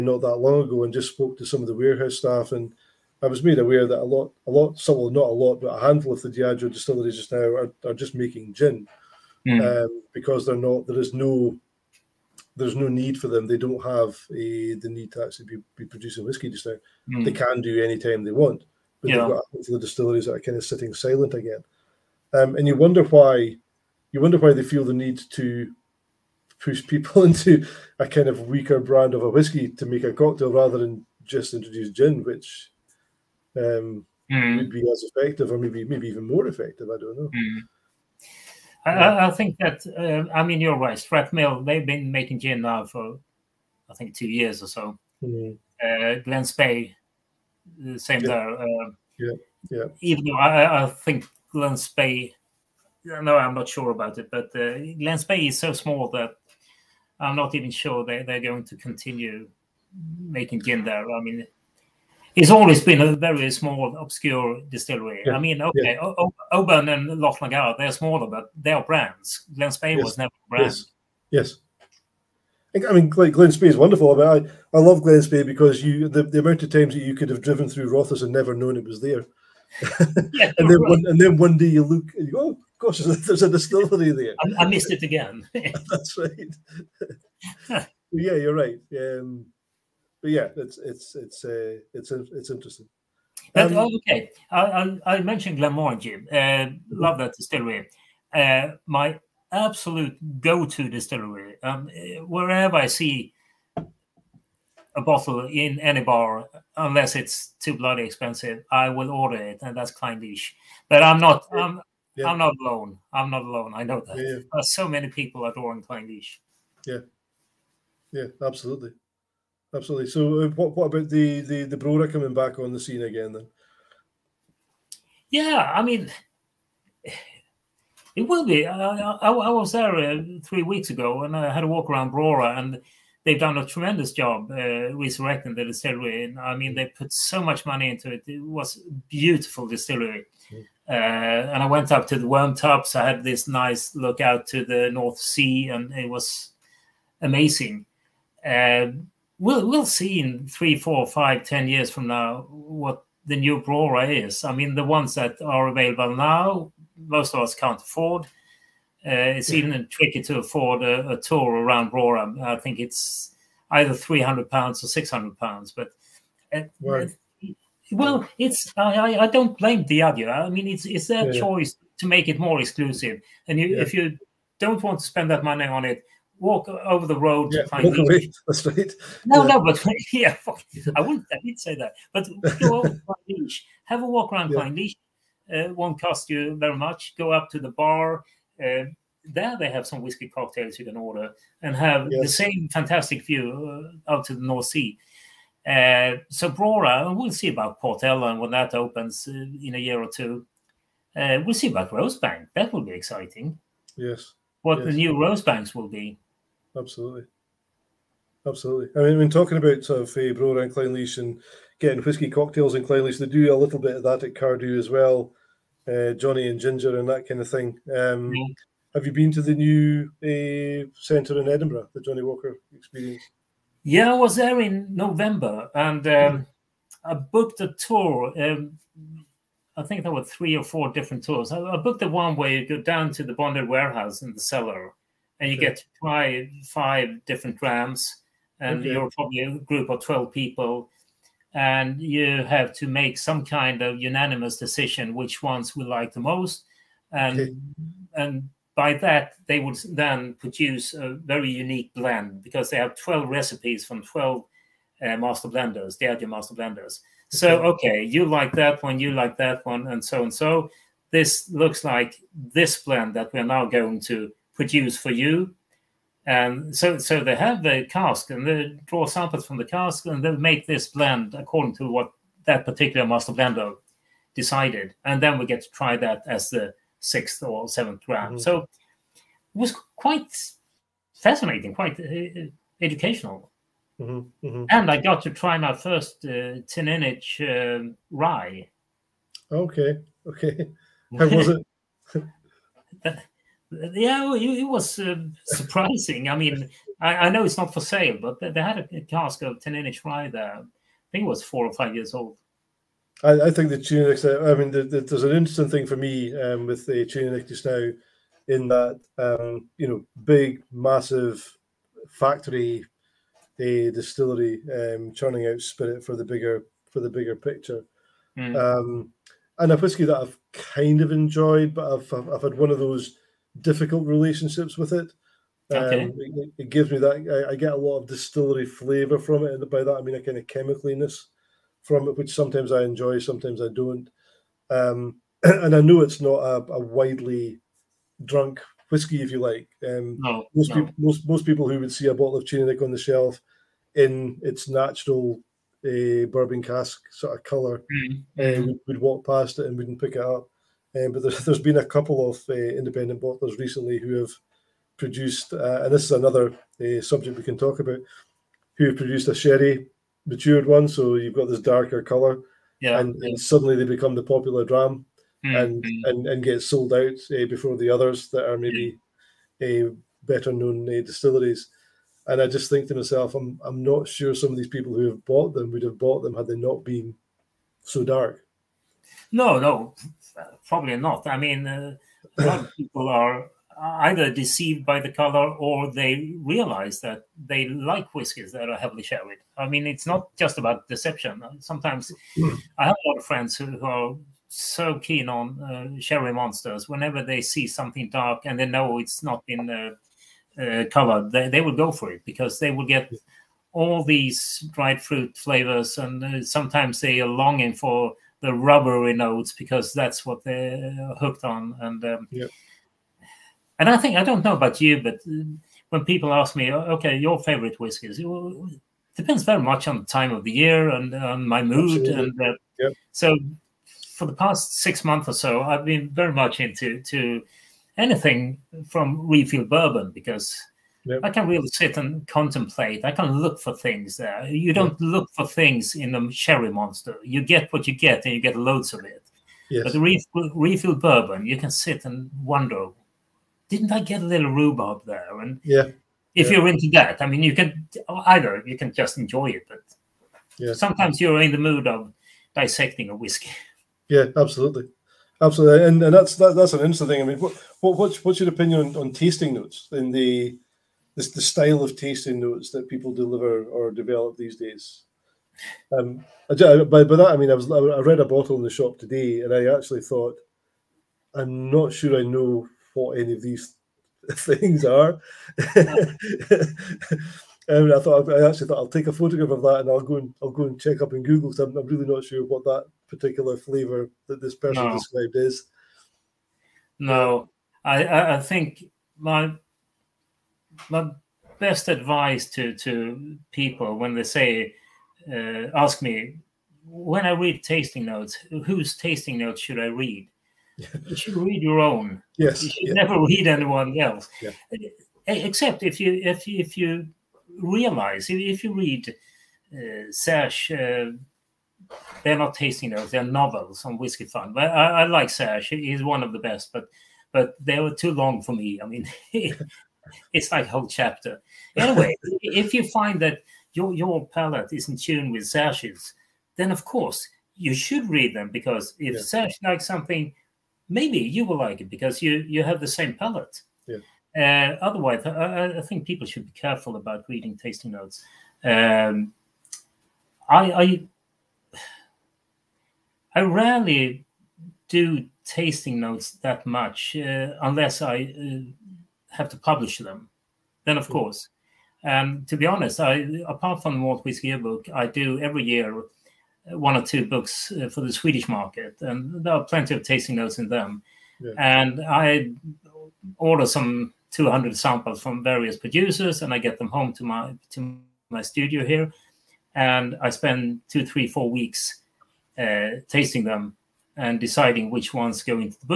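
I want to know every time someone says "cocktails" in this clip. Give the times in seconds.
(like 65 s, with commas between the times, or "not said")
30 s, 190 s, 212 s.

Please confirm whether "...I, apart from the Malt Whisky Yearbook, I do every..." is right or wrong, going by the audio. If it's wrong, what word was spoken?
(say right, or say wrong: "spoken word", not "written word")
right.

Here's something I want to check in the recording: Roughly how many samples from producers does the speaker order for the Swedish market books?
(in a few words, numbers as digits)
200.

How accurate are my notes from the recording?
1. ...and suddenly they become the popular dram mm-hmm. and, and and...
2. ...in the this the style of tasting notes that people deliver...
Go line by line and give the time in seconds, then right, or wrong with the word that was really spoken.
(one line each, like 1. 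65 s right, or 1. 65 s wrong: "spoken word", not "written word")
1. 363 s right
2. 459 s right.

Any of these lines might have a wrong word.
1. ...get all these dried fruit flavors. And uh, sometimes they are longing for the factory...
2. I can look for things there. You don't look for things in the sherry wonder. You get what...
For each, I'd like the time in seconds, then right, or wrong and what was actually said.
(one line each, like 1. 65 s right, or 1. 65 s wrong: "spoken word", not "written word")
1. 402 s wrong: "rubbery", not "factory"
2. 433 s wrong: "monster", not "wonder".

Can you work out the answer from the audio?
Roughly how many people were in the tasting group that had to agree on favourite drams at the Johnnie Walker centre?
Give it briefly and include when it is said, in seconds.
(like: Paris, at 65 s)
12, at 240 s.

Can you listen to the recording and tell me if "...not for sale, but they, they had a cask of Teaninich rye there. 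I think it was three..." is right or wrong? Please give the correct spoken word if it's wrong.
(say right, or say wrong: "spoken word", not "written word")
wrong: "four", not "three".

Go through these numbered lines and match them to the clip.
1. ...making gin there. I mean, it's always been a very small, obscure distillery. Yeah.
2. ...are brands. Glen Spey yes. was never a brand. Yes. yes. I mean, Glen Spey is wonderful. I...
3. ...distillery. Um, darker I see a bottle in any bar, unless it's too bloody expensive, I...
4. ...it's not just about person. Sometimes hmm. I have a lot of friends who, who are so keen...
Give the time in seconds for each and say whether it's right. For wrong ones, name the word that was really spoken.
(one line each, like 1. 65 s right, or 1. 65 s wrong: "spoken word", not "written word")
1. 60 s right
2. 68 s right
3. 100 s wrong: "wherever", not "darker"
4. 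389 s wrong: "deception", not "person".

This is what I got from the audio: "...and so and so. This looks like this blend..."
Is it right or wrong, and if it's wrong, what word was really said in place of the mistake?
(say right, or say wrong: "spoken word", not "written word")
right.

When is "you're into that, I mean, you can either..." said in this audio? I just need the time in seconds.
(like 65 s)
446 s.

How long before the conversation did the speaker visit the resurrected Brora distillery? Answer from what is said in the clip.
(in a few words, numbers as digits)
3 weeks.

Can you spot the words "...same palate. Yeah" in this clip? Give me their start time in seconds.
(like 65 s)
532 s.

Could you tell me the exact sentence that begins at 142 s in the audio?
I had this nice look out to the North Sea, and it was amazing.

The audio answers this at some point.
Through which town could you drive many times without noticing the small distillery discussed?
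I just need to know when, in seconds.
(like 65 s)
77 s.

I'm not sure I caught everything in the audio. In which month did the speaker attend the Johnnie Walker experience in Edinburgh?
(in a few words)
November.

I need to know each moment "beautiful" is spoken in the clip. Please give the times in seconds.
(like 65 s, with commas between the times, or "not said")
139 s.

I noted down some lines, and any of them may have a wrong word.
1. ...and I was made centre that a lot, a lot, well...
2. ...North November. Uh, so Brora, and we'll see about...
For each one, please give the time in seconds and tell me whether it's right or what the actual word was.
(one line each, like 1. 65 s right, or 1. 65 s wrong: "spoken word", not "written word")
1. 2 s wrong: "aware", not "centre"
2. 194 s wrong: "Sea", not "November".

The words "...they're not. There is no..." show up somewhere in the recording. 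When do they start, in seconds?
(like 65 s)
10 s.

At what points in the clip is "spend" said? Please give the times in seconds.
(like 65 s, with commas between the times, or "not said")
175 s, 570 s.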